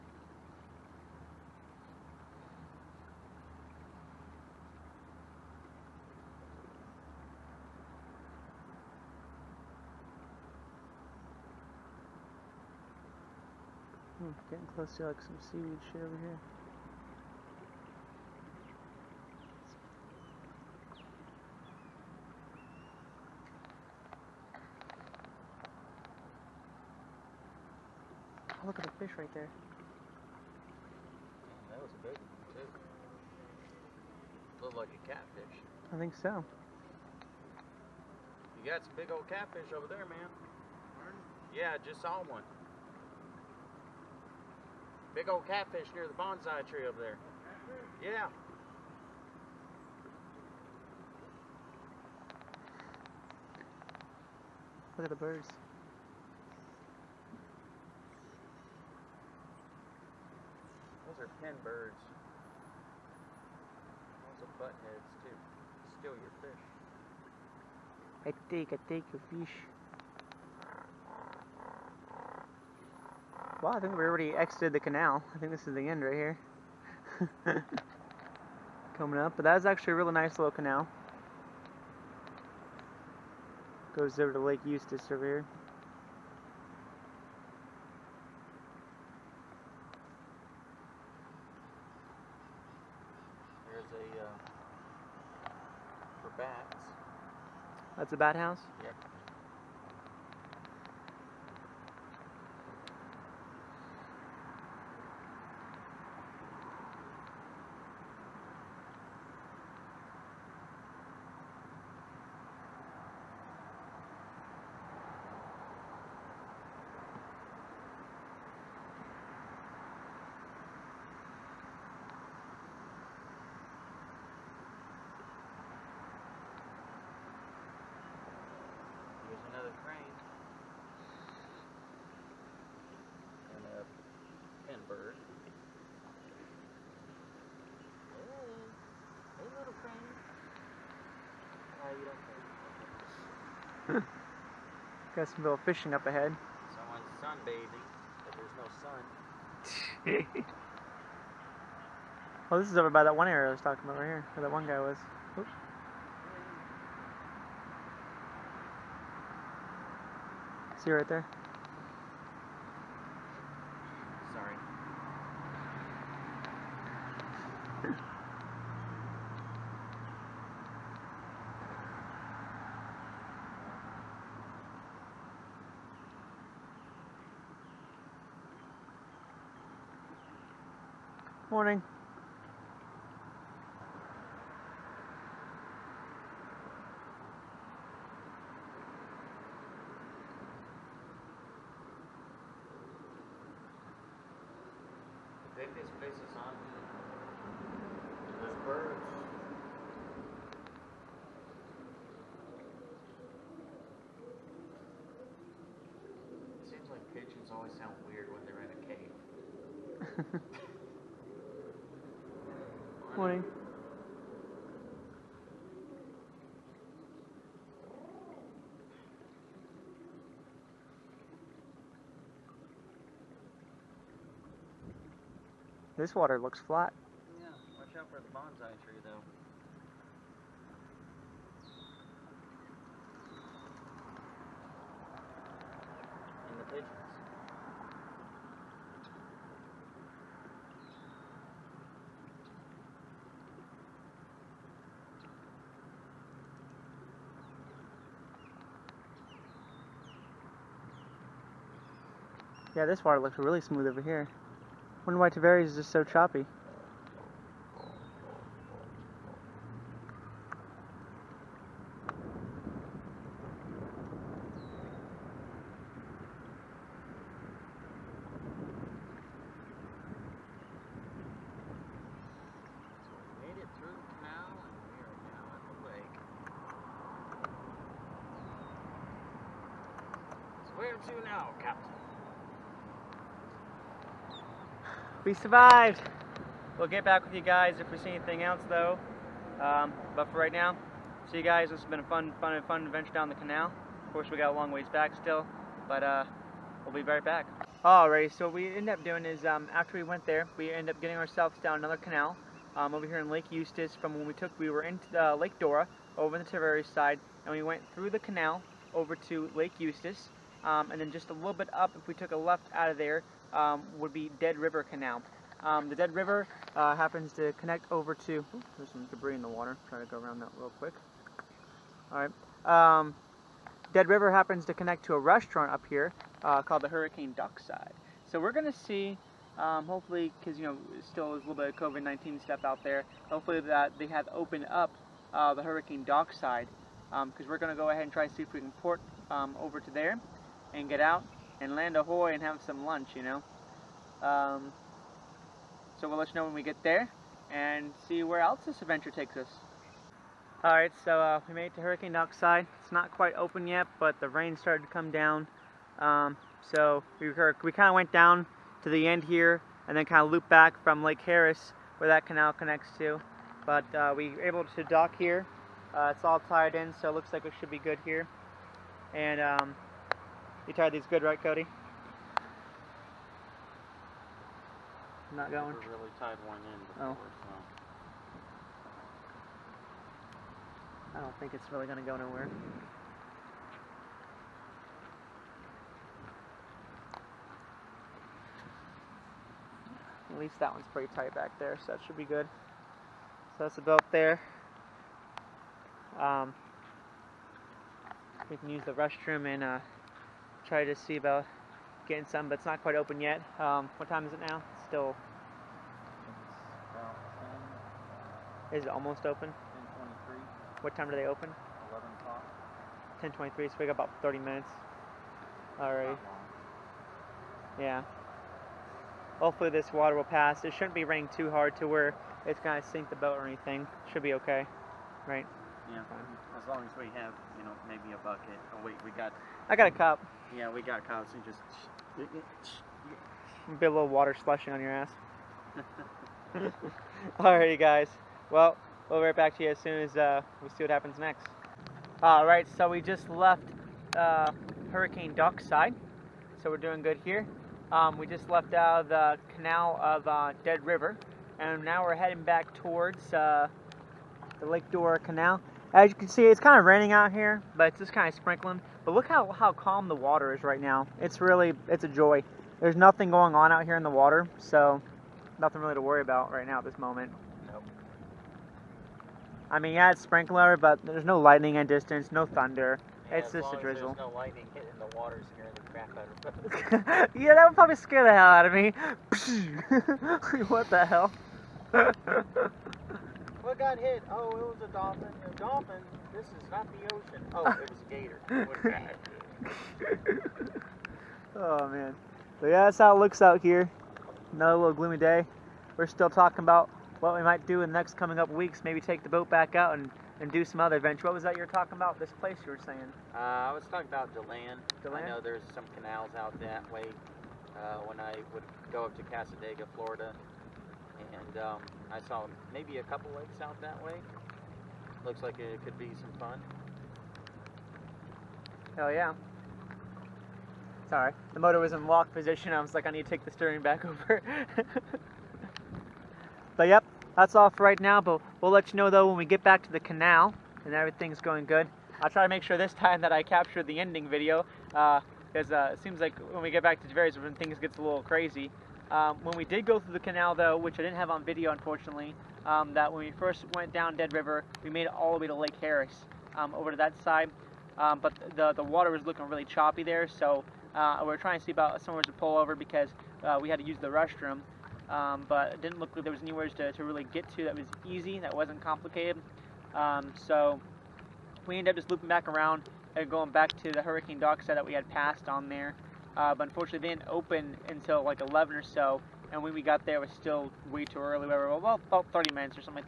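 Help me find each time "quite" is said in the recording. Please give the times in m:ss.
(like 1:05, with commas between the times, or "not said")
5:53, 6:42.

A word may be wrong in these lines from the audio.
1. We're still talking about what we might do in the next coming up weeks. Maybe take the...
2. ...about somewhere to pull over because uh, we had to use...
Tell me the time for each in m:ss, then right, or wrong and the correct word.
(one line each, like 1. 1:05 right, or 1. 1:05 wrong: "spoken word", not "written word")
1. 8:15 right
2. 9:11 right.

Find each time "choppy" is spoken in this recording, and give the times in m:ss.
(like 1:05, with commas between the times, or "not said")
4:16, 9:09.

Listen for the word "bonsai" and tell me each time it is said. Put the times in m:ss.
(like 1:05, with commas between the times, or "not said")
0:46, 3:48.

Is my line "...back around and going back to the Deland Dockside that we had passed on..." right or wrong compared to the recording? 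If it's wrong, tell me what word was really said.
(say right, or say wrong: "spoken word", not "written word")
wrong: "Hurricane", not "Deland".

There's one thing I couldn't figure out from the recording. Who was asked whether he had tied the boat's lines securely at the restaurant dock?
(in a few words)
Cody.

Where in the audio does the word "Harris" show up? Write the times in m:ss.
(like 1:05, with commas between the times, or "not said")
6:01, 9:05.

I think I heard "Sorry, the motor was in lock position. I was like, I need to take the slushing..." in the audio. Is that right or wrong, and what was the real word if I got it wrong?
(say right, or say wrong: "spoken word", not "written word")
wrong: "steering", not "slushing".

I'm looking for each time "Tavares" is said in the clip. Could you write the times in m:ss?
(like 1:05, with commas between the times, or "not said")
4:15, 5:06, 8:57.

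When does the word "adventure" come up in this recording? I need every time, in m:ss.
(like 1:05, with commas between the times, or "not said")
4:52, 5:48, 8:20.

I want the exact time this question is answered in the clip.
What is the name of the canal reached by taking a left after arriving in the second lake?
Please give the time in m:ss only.
5:14.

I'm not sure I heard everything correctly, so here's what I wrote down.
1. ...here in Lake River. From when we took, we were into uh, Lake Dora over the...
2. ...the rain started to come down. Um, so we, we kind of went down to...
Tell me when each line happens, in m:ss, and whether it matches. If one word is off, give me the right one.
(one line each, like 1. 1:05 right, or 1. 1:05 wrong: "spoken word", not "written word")
1. 5:03 wrong: "Eustis", not "River"
2. 5:54 right.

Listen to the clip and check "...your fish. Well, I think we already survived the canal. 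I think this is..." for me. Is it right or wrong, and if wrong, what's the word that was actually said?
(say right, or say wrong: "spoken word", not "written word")
wrong: "exited", not "survived".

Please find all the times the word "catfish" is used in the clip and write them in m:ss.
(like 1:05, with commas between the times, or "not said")
0:35, 0:39, 0:45.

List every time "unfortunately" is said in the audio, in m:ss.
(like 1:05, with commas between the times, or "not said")
9:01, 9:26.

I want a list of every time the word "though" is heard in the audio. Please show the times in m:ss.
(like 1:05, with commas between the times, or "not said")
3:49, 4:48, 8:49, 9:00.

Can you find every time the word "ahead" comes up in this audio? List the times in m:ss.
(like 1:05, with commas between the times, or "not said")
2:26, 5:37.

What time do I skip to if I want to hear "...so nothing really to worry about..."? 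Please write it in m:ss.
7:44.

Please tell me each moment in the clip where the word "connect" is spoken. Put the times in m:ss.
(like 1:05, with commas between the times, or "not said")
5:17, 5:24, 6:02.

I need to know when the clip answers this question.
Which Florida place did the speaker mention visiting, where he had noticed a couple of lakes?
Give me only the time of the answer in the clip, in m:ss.
8:29.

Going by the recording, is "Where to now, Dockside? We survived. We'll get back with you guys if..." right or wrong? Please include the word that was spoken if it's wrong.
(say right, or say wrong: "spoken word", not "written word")
wrong: "Captain", not "Dockside".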